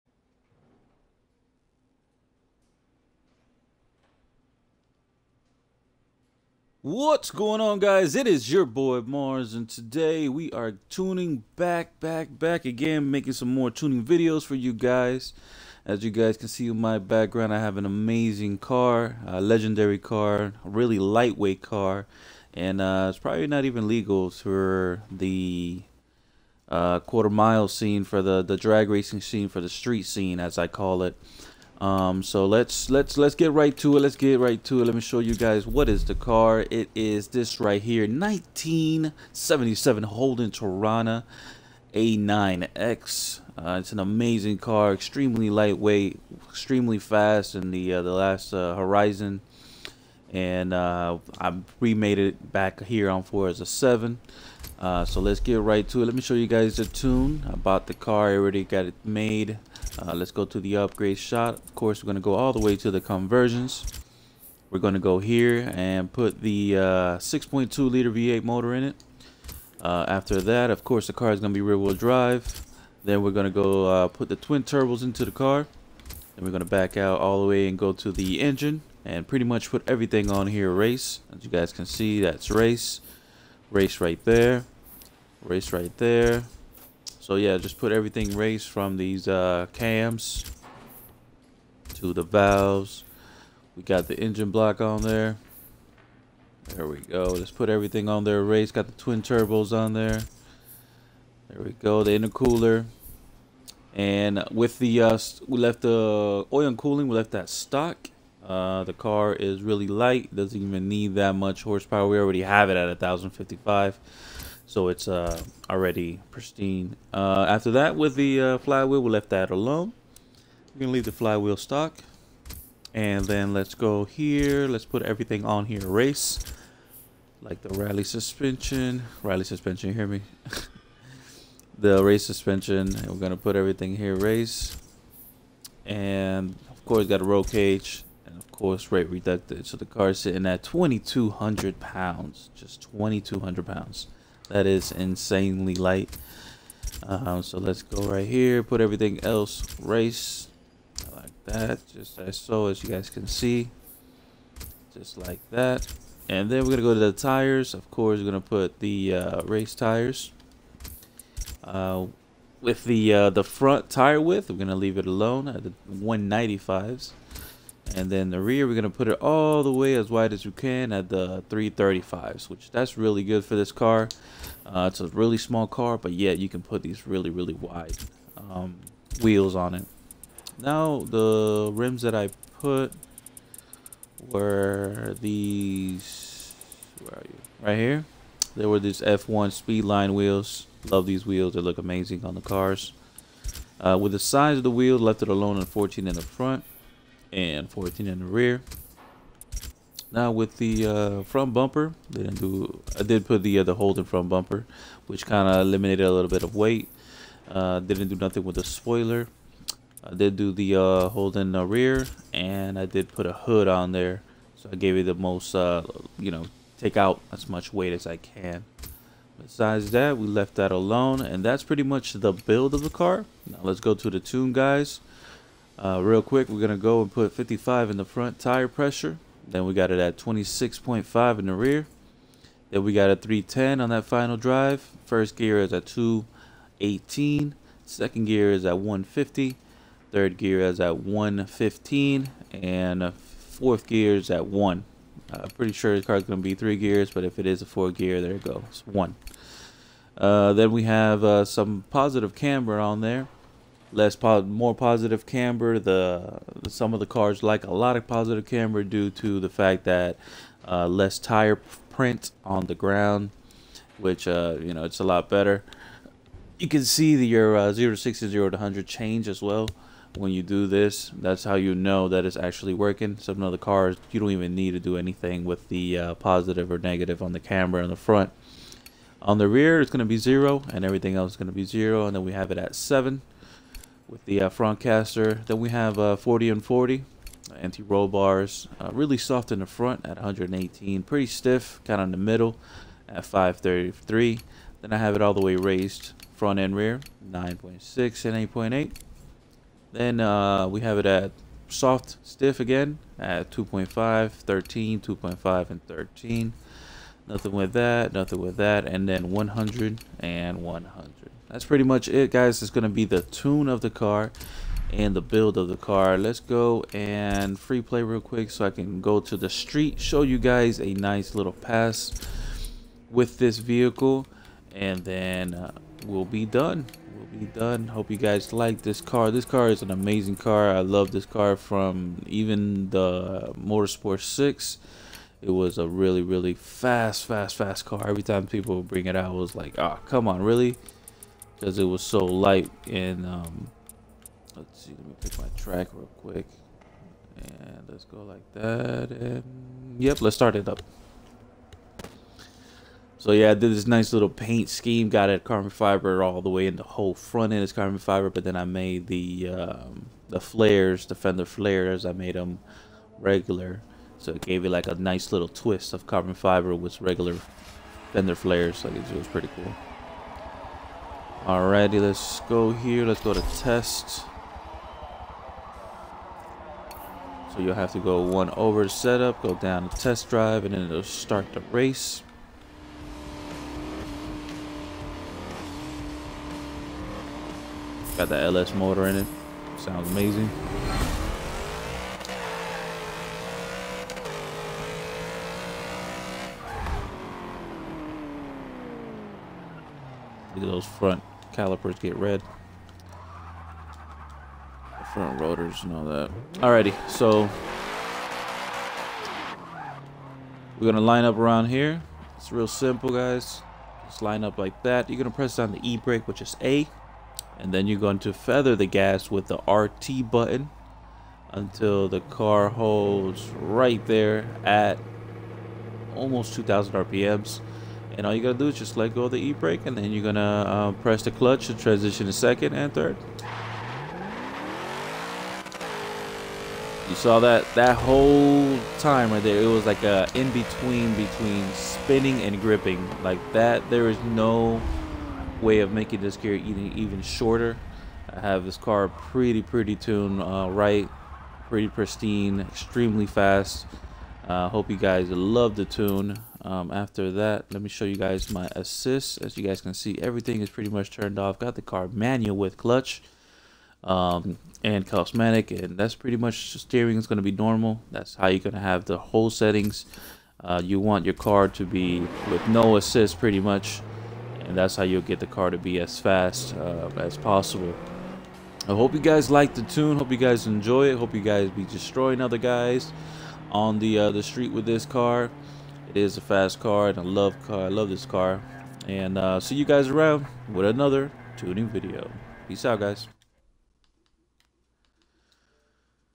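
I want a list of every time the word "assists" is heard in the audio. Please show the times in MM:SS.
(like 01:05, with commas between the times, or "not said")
07:38, 07:52.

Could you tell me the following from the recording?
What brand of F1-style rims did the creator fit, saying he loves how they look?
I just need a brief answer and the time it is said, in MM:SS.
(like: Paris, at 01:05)
Speedline, at 03:09.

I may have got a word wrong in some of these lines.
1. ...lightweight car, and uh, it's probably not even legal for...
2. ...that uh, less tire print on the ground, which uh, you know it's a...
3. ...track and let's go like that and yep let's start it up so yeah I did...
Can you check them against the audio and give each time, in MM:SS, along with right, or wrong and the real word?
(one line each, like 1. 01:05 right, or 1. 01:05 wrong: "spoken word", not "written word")
1. 00:20 right
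2. 04:19 right
3. 05:46 wrong: "quick", not "track".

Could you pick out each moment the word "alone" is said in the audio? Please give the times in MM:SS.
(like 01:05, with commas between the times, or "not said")
01:59, 02:45, 03:15, 03:40.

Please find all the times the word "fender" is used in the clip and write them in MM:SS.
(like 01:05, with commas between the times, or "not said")
06:01, 06:08.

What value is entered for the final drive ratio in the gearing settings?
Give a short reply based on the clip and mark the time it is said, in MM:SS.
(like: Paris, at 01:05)
310, at 03:53.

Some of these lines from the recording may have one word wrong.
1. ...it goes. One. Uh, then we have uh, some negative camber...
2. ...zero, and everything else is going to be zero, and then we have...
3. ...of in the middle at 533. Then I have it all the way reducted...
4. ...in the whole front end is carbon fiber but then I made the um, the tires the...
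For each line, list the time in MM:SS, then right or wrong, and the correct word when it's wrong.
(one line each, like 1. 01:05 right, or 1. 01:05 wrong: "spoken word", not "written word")
1. 04:08 wrong: "positive", not "negative"
2. 04:40 right
3. 04:52 wrong: "raised", not "reducted"
4. 05:56 wrong: "flares", not "tires".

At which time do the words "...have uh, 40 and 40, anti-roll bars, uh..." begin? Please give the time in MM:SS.
04:45.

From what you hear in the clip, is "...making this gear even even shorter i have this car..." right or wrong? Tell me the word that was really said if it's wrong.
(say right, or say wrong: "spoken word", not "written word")
right.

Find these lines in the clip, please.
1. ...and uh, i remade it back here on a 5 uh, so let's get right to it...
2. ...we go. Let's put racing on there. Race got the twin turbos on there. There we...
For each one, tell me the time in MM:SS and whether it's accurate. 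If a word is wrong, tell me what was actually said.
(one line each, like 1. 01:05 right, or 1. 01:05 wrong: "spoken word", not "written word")
1. 00:50 wrong: "7", not "5"
2. 01:36 wrong: "everything", not "racing".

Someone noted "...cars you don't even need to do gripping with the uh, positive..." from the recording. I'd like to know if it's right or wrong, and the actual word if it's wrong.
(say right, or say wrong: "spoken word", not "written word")
wrong: "anything", not "gripping".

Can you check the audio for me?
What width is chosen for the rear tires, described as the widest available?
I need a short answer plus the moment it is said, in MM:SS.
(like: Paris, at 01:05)
335, at 02:51.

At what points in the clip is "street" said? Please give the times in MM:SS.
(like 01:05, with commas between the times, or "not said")
00:29, 05:19, 08:04.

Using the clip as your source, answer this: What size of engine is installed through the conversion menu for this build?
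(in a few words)
6.2 liter V8.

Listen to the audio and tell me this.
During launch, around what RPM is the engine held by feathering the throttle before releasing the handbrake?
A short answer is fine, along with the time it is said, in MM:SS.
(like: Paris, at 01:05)
2,000, at 07:06.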